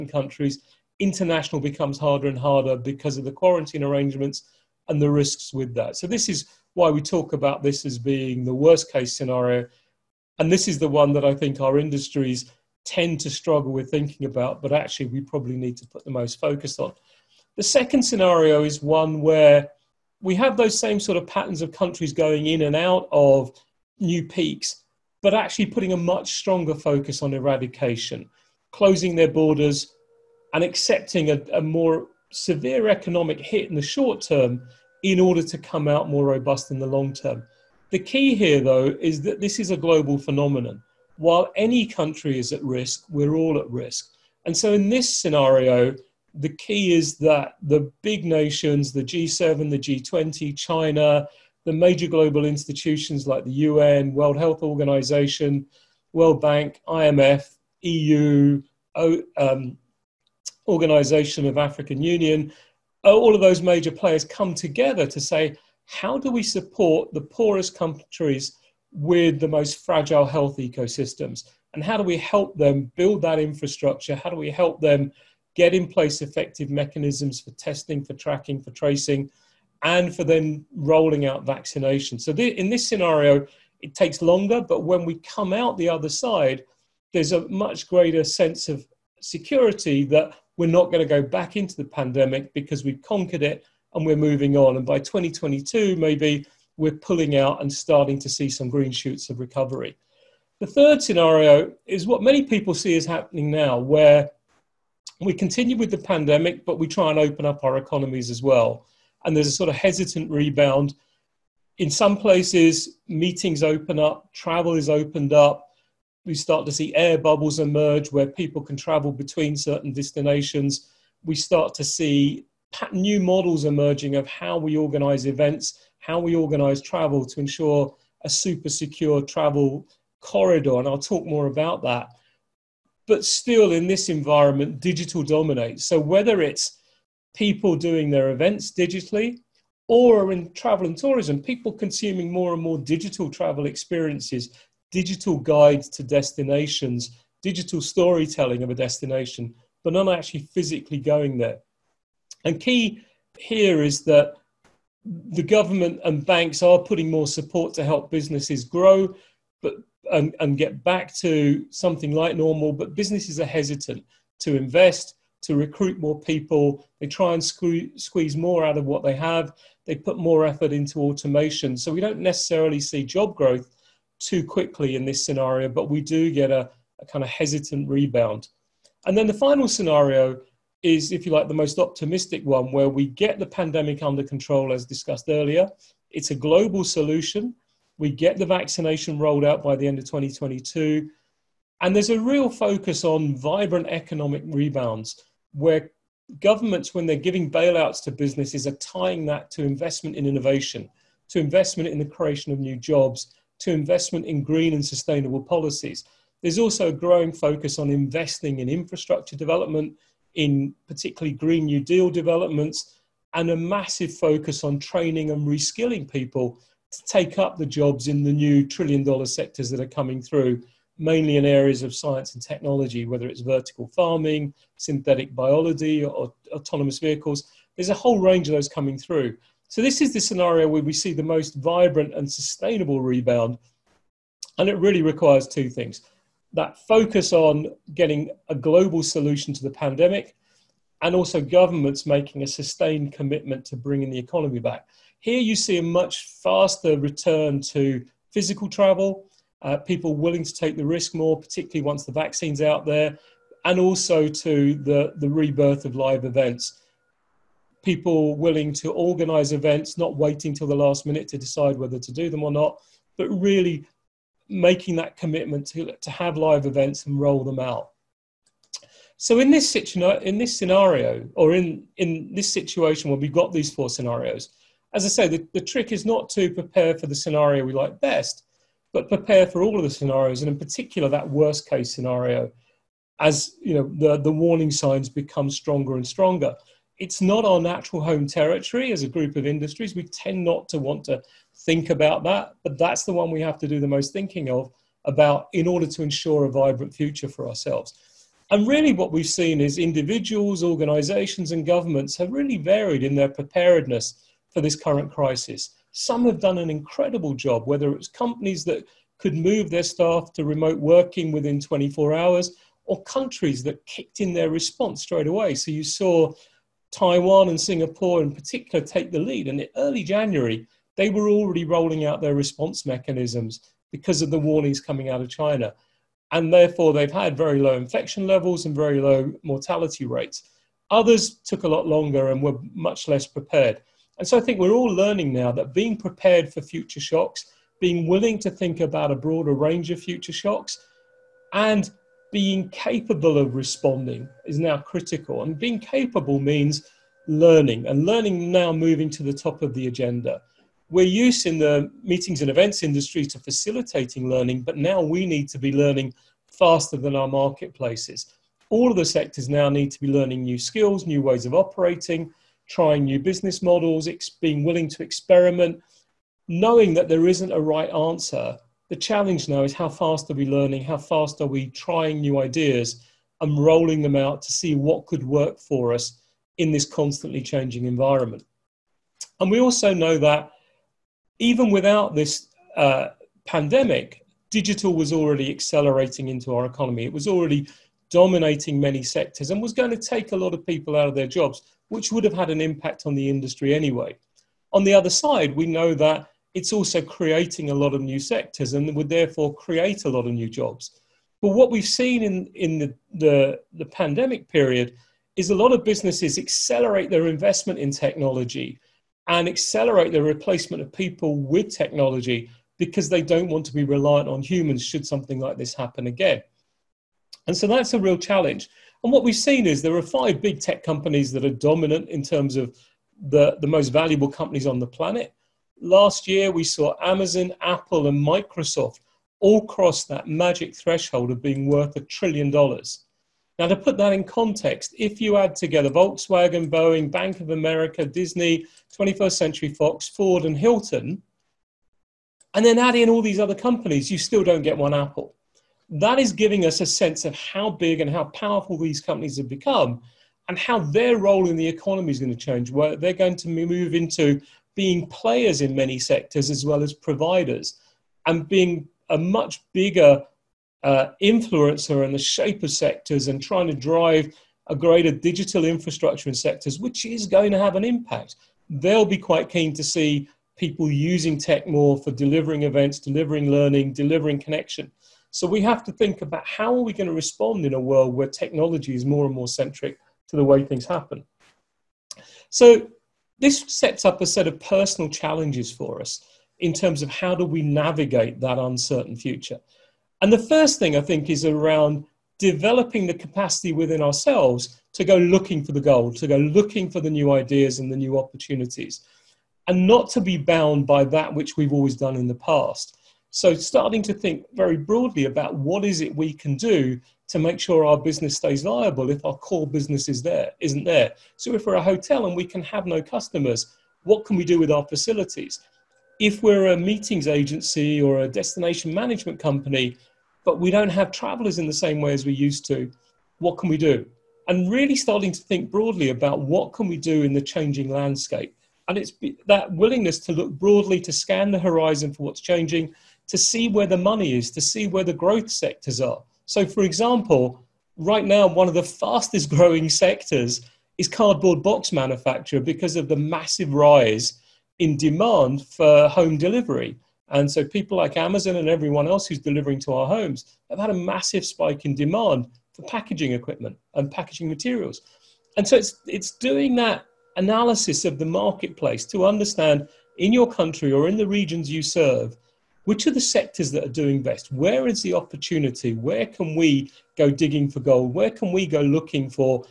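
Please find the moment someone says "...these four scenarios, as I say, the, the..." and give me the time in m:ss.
4:33.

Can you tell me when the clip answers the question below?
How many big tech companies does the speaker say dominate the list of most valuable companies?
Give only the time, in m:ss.
7:00.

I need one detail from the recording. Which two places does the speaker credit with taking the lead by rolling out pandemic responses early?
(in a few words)
Taiwan and Singapore.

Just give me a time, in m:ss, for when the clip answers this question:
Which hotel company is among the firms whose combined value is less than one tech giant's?
7:20.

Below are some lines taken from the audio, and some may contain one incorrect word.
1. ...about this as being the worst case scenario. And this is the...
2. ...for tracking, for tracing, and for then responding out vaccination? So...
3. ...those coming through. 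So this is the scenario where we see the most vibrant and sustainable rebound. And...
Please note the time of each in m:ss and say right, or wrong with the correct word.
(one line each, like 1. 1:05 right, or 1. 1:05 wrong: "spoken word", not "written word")
1. 0:07 right
2. 1:18 wrong: "rolling", not "responding"
3. 3:48 right.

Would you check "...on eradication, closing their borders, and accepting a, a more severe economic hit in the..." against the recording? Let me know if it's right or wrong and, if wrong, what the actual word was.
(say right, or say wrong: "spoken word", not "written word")
right.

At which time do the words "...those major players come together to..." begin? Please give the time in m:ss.
1:03.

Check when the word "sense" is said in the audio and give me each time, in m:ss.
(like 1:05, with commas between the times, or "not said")
1:28, 7:26.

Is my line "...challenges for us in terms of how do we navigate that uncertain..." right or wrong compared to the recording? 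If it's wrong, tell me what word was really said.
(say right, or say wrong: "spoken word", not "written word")
right.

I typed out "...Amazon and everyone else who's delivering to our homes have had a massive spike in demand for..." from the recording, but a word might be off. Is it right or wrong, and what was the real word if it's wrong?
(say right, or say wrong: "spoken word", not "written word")
right.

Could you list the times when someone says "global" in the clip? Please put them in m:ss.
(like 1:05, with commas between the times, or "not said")
0:39, 0:52, 3:06, 3:58.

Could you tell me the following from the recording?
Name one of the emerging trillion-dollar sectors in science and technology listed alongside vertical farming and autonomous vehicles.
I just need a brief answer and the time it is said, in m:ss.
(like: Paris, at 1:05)
synthetic biology, at 3:44.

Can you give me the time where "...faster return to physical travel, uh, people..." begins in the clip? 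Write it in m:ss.
4:06.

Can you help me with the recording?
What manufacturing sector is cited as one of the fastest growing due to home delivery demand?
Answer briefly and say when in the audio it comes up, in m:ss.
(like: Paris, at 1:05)
cardboard box manufacture, at 9:01.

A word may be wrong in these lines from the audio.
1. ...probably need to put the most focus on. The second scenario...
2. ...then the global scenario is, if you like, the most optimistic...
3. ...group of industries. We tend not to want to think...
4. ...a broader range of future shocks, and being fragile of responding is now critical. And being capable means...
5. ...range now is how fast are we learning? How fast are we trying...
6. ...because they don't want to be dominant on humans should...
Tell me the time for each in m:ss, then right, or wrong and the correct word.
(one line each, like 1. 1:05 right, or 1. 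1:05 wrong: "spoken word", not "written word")
1. 0:15 right
2. 2:59 wrong: "final", not "global"
3. 4:49 right
4. 5:39 wrong: "capable", not "fragile"
5. 6:08 wrong: "challenge", not "range"
6. 6:52 wrong: "reliant", not "dominant".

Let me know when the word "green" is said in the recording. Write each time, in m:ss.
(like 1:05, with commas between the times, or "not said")
1:38, 3:24, 3:31.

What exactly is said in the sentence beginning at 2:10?
And I'll talk more about that.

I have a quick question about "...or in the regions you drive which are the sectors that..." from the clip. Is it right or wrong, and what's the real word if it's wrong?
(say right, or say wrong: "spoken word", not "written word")
wrong: "serve", not "drive".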